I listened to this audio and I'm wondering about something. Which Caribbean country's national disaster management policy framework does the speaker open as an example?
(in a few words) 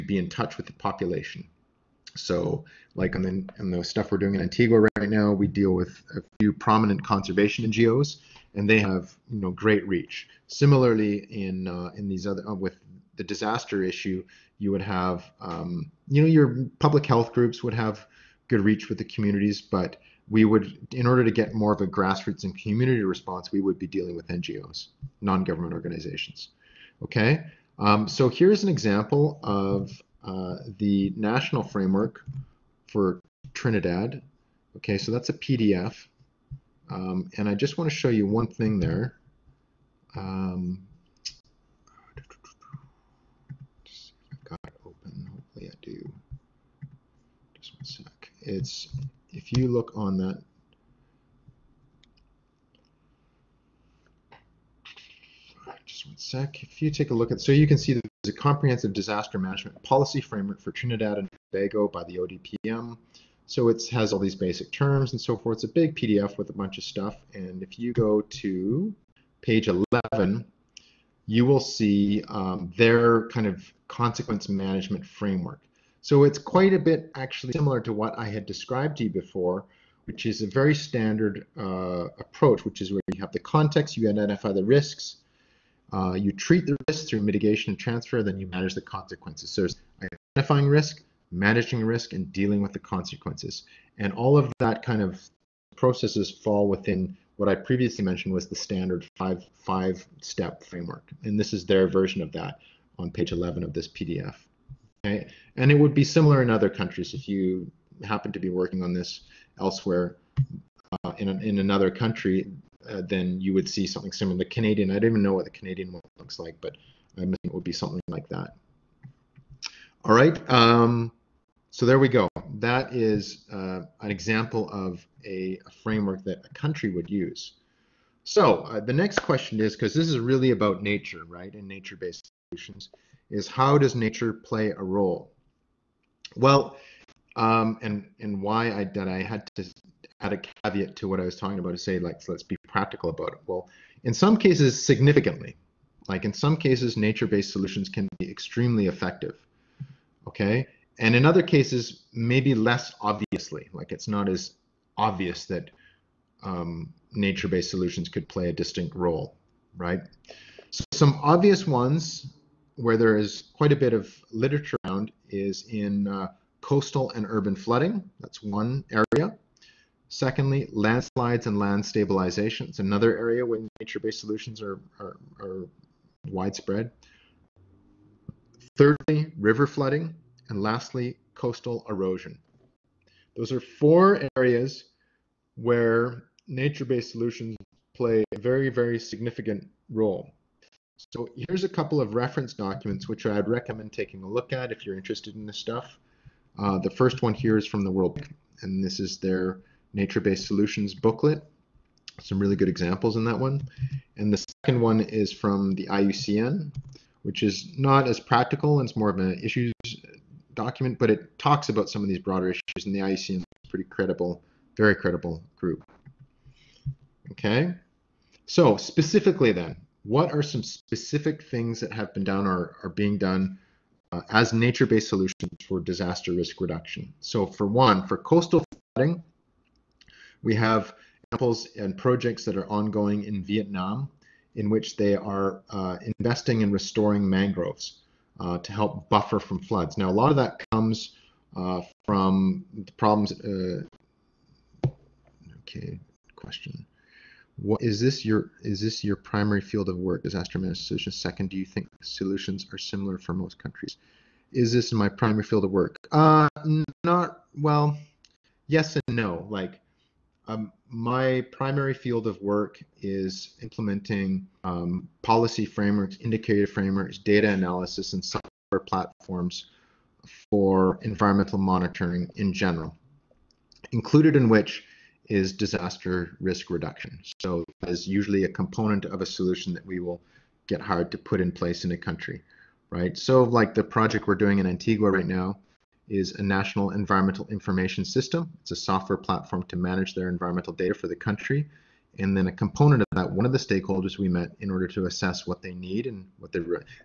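Trinidad and Tobago.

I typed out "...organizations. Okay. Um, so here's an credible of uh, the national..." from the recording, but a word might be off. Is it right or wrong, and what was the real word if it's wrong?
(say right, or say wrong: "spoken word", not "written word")
wrong: "example", not "credible".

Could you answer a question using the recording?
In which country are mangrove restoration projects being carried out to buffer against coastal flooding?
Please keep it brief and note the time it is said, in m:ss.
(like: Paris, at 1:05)
Vietnam, at 3:53.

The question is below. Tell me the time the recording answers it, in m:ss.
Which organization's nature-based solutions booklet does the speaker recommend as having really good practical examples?
3:17.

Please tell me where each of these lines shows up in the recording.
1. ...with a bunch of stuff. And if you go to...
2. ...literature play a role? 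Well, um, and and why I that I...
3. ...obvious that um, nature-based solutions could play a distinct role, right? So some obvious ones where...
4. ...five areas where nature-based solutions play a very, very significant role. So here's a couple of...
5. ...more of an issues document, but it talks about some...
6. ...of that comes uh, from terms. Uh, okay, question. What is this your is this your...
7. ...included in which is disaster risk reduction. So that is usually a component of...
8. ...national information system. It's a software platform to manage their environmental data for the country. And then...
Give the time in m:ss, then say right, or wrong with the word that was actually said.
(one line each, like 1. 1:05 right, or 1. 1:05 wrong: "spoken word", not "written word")
1. 1:06 right
2. 2:13 wrong: "nature", not "literature"
3. 2:34 right
4. 3:03 wrong: "four", not "five"
5. 3:28 right
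6. 4:00 wrong: "problems", not "terms"
7. 4:33 right
8. 4:46 wrong: "environmental", not "national".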